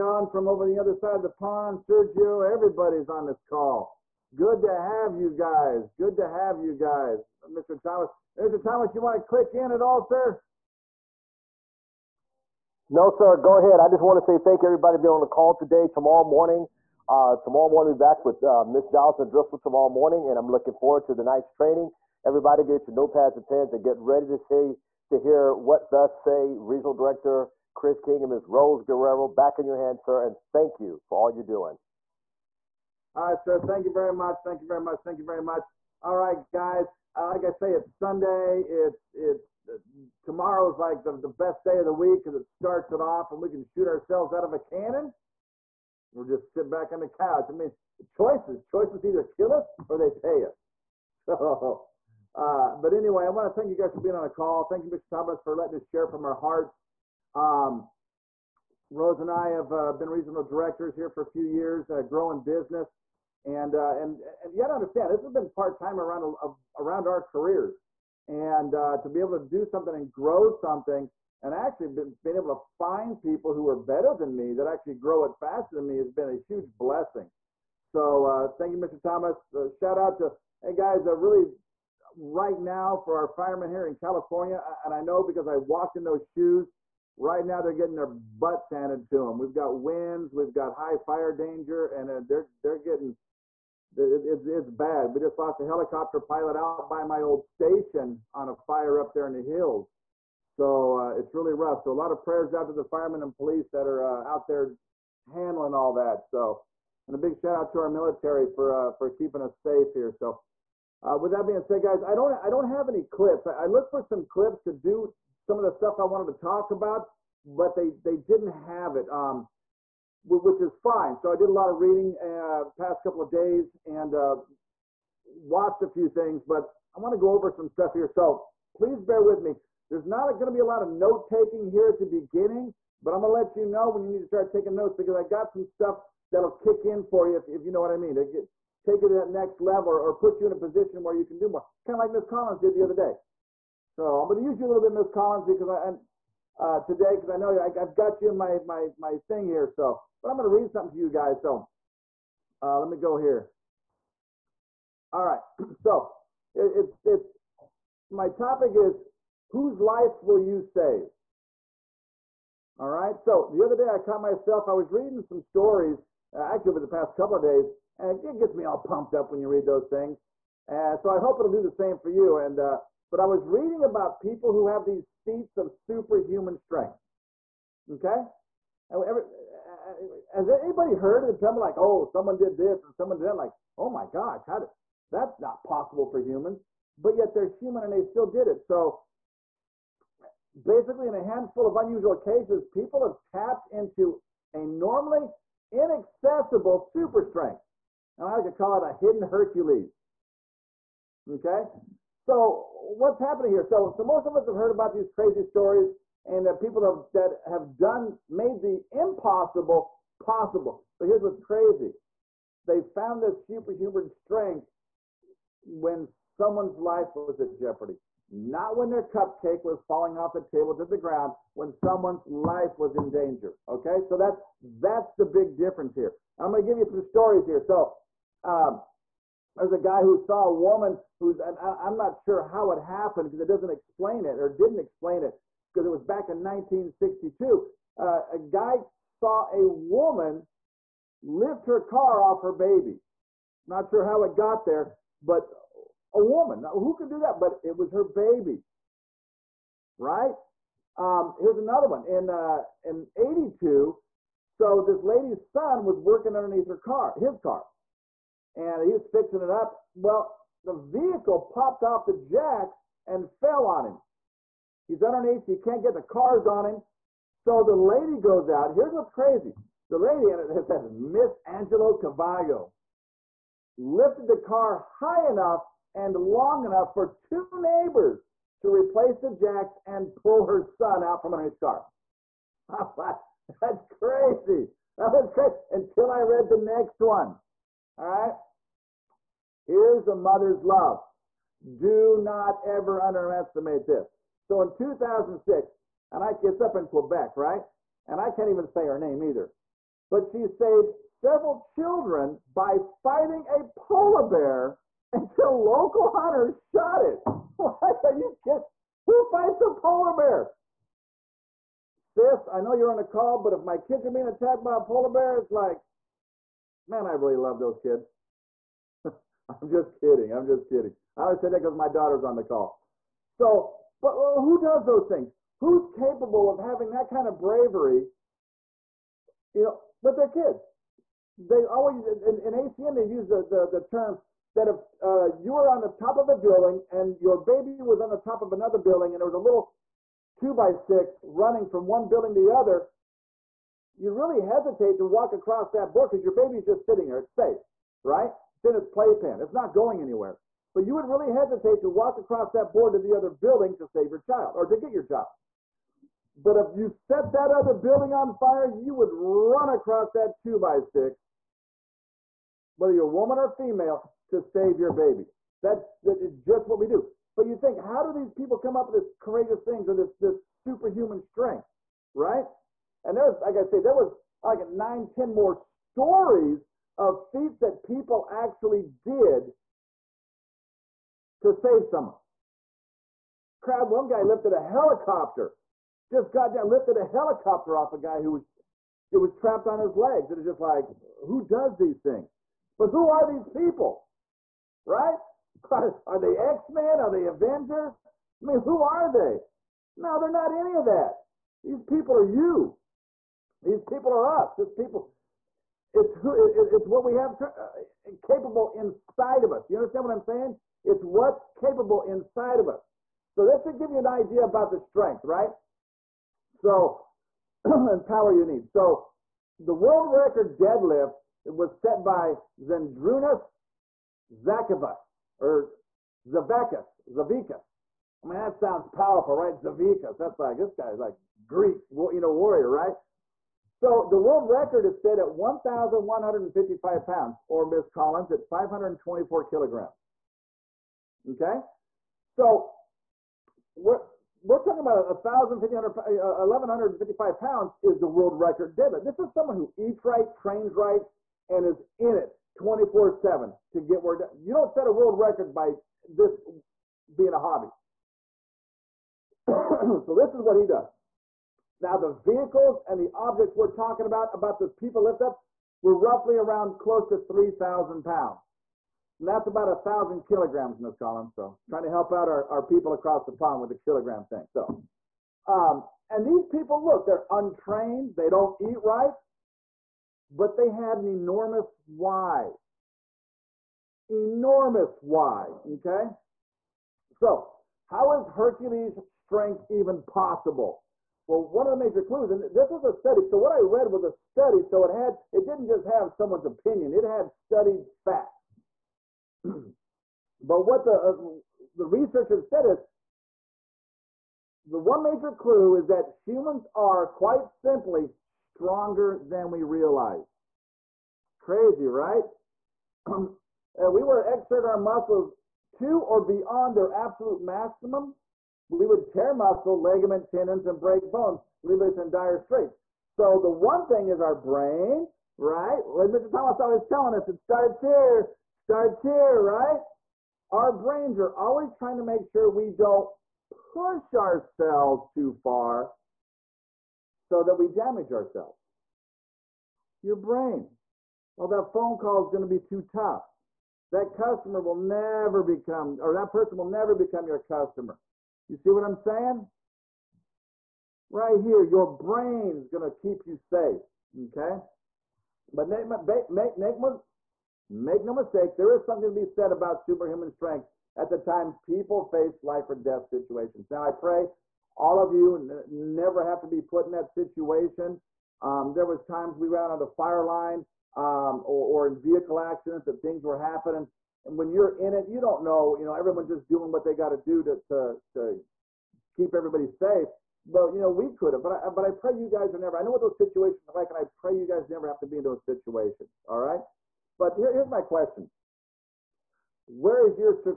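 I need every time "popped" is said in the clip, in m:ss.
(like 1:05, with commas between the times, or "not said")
4:21.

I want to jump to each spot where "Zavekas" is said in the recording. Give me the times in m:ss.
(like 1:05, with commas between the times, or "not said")
7:06.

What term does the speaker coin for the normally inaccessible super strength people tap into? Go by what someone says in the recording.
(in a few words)
hidden Hercules.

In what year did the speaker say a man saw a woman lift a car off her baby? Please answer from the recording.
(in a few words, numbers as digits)
1962.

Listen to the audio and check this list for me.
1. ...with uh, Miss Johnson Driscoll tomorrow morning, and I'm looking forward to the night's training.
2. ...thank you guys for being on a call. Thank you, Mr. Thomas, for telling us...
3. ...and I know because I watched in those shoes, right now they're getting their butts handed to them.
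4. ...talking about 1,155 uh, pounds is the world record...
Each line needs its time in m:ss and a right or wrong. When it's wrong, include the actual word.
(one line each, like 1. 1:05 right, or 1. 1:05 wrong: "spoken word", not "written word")
1. 0:18 right
2. 0:53 wrong: "letting", not "telling"
3. 1:24 wrong: "walked", not "watched"
4. 7:24 right.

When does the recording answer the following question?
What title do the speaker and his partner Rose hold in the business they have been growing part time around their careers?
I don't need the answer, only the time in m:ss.
1:00.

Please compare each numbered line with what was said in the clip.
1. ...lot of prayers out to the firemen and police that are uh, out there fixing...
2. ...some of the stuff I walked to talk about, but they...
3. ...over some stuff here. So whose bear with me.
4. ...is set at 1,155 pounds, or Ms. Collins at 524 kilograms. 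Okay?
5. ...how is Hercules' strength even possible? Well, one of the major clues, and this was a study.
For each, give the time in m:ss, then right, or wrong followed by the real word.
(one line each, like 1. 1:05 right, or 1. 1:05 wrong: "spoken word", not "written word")
1. 1:41 wrong: "handling", not "fixing"
2. 1:55 wrong: "wanted", not "walked"
3. 2:07 wrong: "please", not "whose"
4. 7:14 right
5. 8:07 right.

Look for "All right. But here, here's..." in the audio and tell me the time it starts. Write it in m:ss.
9:46.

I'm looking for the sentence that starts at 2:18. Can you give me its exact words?
It, take you to that next level or, put you in a position where you can do more.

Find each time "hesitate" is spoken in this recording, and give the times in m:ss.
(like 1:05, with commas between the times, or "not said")
5:44, 5:51.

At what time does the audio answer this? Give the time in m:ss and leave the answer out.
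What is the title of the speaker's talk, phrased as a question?
2:39.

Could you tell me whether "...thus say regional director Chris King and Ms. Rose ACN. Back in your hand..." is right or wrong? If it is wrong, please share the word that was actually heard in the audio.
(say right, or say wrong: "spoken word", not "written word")
wrong: "Guerrero", not "ACN".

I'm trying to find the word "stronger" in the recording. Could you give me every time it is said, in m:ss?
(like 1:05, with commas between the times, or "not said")
8:28.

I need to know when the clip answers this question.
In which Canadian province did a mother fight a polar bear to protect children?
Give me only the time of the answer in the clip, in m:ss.
4:56.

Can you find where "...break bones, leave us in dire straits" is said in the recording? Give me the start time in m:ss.
8:40.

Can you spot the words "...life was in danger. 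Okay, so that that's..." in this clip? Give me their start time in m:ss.
3:42.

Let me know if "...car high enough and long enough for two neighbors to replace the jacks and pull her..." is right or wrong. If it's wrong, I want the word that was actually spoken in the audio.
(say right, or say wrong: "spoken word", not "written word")
right.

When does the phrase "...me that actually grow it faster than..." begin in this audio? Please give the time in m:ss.
1:14.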